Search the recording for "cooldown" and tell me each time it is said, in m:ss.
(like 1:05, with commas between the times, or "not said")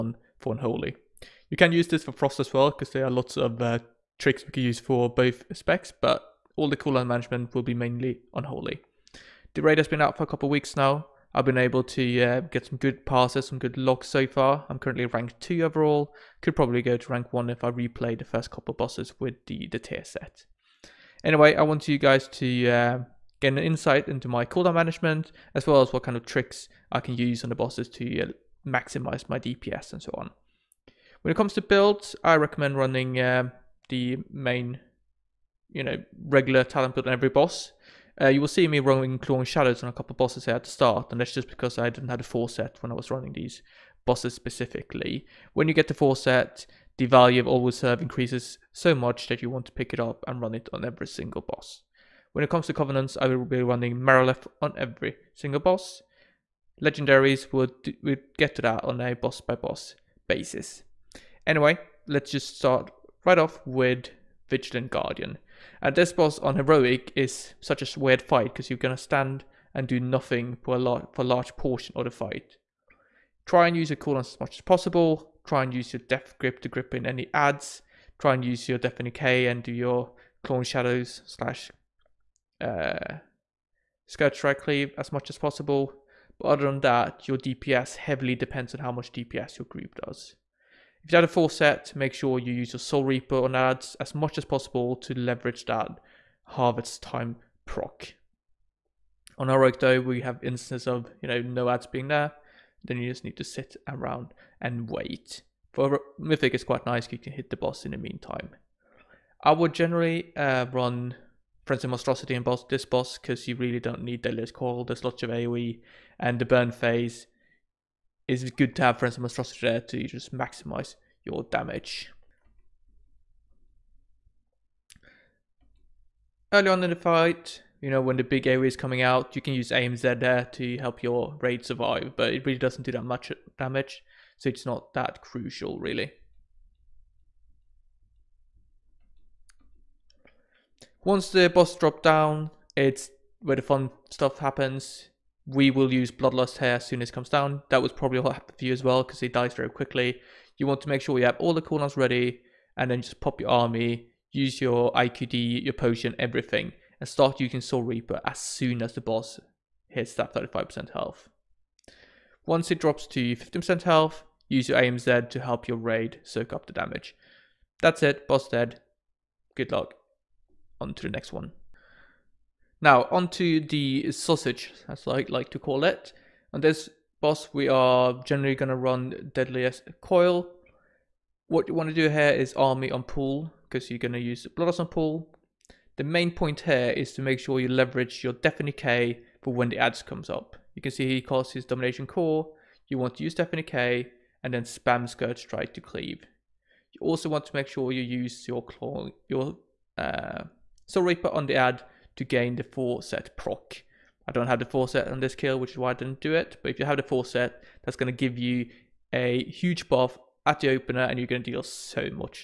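0:06, 0:24, 1:13.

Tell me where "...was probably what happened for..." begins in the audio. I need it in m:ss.
2:27.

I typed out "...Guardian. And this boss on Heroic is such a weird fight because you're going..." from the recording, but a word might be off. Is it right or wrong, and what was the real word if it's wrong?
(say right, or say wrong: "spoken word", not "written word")
right.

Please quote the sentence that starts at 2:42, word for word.
Once it drops to 15% health, use your AMZ to help your raid soak up the damage.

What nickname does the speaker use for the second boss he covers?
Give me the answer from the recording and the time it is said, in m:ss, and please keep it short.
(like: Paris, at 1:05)
the sausage, at 2:53.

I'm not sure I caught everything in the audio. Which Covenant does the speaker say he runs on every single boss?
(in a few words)
Marileth.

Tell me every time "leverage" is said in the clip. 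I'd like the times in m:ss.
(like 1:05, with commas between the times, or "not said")
1:35, 3:07.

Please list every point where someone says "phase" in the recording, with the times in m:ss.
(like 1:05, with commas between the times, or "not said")
1:56.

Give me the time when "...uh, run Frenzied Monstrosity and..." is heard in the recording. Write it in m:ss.
1:50.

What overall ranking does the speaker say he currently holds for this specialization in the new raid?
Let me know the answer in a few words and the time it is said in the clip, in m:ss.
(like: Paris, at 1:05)
2, at 0:15.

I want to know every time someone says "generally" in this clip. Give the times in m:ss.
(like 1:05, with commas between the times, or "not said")
1:49, 2:58.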